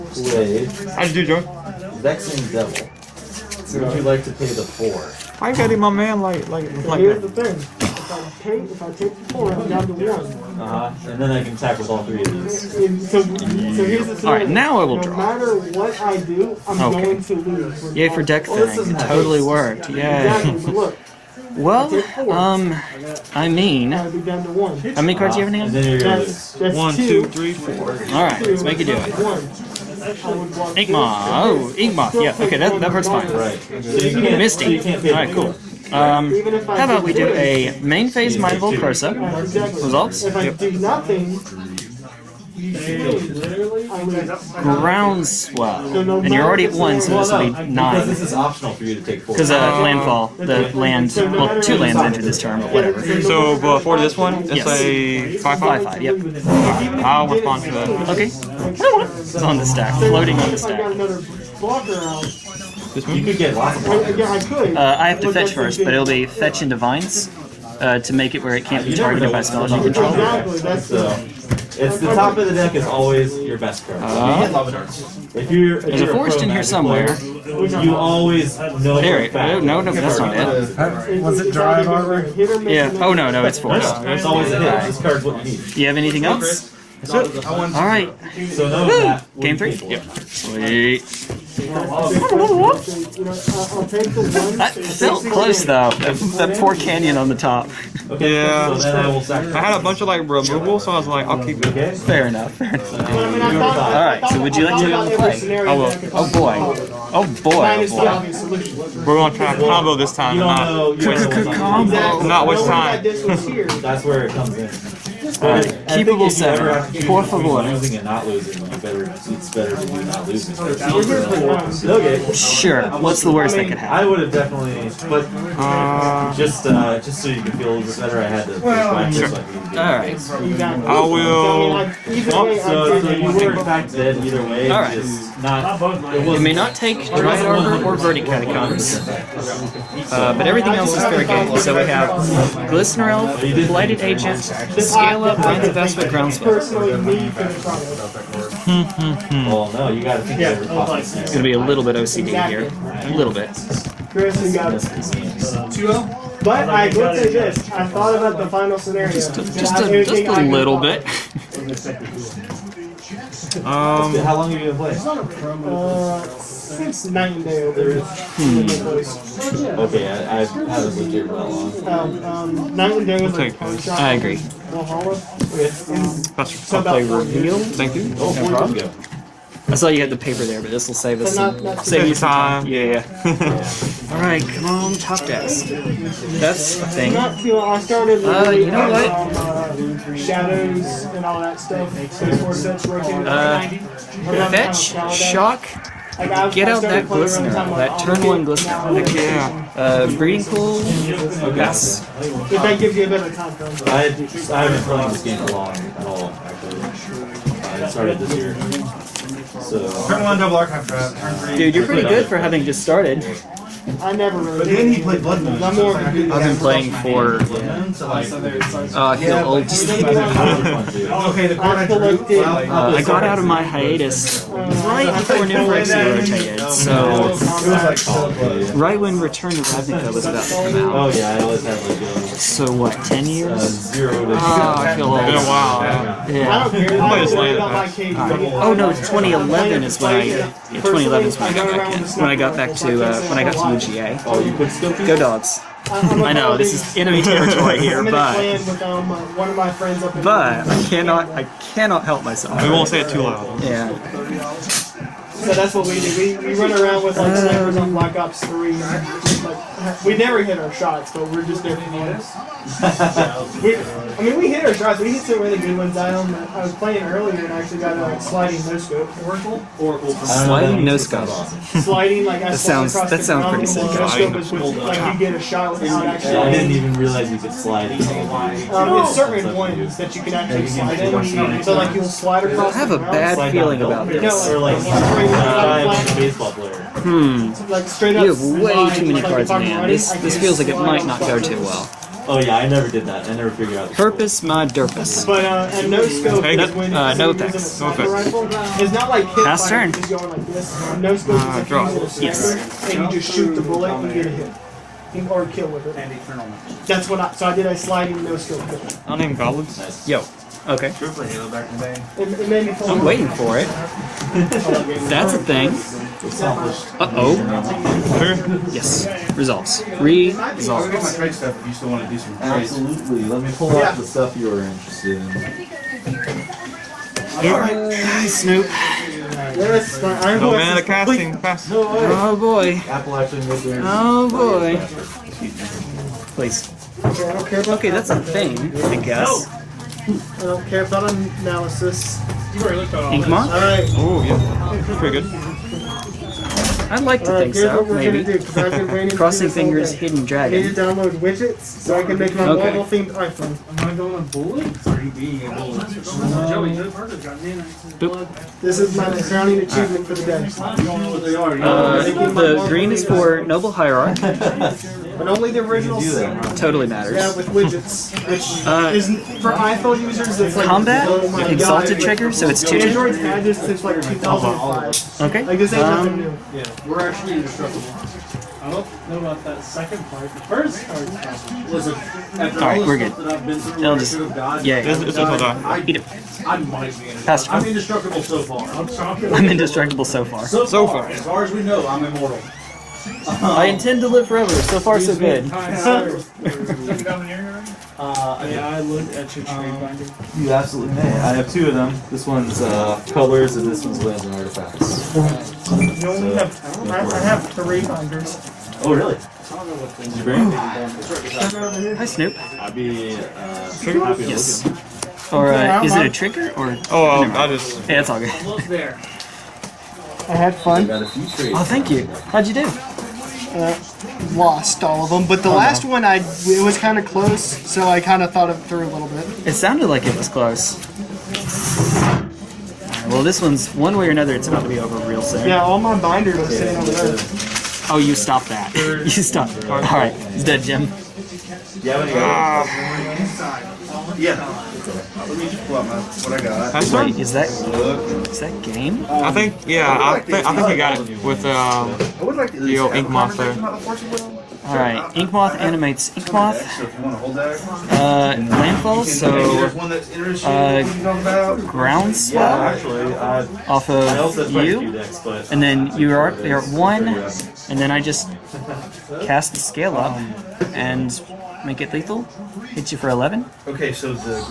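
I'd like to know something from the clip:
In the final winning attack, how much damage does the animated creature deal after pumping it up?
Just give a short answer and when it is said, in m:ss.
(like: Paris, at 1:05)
11, at 7:53.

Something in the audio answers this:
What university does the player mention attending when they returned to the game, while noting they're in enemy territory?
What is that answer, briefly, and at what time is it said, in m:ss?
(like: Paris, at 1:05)
UGA, at 4:03.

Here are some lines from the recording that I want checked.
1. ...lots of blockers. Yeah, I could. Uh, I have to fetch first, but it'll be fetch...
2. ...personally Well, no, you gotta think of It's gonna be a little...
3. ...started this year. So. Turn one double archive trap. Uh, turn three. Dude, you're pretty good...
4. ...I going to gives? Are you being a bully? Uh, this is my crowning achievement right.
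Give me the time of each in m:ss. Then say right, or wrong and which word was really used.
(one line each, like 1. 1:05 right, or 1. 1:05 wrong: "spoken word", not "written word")
1. 1:03 right
2. 2:26 right
3. 3:27 right
4. 5:53 wrong: "bullies", not "gives".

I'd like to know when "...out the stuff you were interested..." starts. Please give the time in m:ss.
5:23.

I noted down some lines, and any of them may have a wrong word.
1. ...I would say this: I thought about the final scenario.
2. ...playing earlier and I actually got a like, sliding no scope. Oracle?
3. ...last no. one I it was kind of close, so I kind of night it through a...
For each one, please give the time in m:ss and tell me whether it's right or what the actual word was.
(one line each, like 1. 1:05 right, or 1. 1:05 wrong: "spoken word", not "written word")
1. 2:36 right
2. 4:26 right
3. 7:05 wrong: "thought", not "night".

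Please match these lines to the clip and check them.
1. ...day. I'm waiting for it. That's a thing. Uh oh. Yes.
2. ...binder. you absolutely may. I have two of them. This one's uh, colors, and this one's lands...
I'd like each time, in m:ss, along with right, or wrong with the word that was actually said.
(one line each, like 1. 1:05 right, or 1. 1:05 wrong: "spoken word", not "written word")
1. 5:12 right
2. 6:39 right.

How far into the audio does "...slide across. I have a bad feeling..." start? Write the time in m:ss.
4:42.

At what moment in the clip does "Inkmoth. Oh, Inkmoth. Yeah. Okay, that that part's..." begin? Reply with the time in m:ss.
0:30.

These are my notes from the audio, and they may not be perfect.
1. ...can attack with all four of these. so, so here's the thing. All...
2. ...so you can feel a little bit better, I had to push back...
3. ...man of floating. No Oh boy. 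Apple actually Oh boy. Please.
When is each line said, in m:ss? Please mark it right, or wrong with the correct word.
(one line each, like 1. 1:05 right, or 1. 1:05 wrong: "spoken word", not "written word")
1. 0:11 wrong: "three", not "four"
2. 2:07 right
3. 5:30 wrong: "casting", not "floating".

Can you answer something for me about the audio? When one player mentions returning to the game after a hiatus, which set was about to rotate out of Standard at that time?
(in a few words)
New Phyrexia.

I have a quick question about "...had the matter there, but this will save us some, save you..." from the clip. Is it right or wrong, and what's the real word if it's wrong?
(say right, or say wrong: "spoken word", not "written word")
wrong: "paper", not "matter".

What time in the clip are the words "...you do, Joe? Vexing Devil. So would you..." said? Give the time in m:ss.
0:01.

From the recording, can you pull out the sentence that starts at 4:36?
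I didn't even realize you could slide in.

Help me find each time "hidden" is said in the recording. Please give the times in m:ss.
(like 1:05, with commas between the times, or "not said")
5:49.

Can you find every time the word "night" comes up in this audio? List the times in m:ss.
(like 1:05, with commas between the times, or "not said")
2:47, 2:52.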